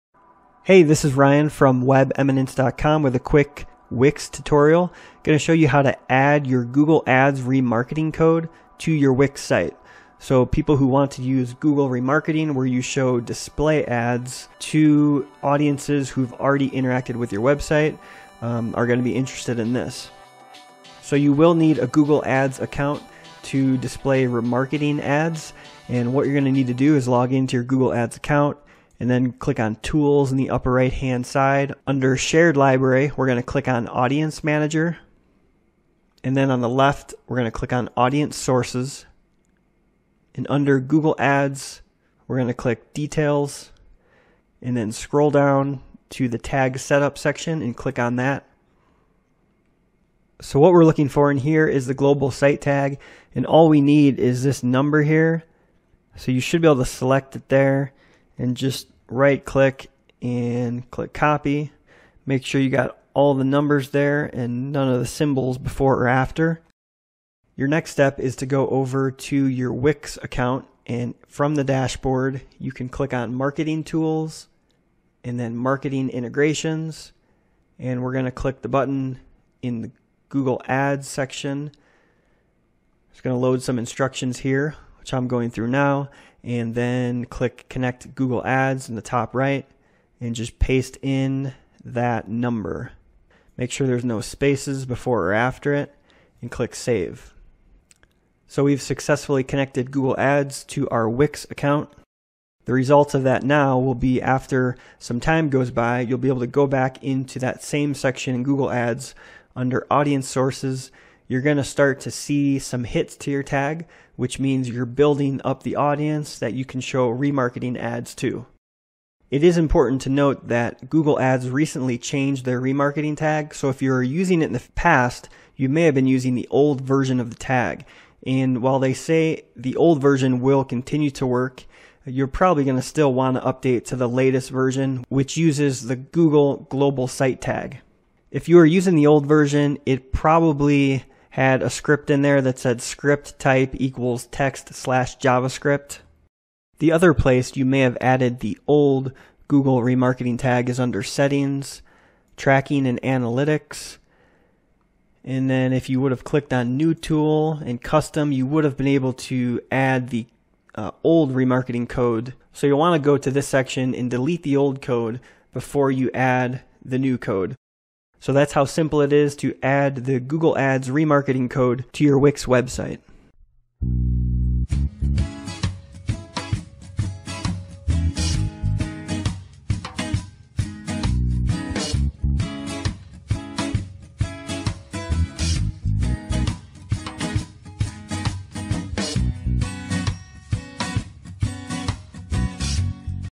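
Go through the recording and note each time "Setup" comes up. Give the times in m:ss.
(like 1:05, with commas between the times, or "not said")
0:46.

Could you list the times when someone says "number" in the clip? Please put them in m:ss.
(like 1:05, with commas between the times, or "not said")
0:54, 1:03, 1:32.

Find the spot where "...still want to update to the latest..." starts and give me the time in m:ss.
2:12.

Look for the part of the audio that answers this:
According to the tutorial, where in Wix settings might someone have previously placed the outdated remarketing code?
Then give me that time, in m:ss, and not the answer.
2:32.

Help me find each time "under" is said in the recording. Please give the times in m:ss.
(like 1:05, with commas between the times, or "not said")
0:31, 0:40, 1:49, 2:30.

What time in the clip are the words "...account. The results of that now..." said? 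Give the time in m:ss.
1:41.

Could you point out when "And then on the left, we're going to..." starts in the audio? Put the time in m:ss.
0:36.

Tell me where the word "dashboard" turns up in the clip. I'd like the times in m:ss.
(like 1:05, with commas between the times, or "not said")
1:11.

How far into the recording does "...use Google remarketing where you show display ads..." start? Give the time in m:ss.
0:11.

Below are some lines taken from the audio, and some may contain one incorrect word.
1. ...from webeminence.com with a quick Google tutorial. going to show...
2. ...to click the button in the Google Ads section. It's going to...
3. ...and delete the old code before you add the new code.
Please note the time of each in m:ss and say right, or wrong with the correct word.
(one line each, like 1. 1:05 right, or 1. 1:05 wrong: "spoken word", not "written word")
1. 0:01 wrong: "Wix", not "Google"
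2. 1:18 right
3. 2:43 right.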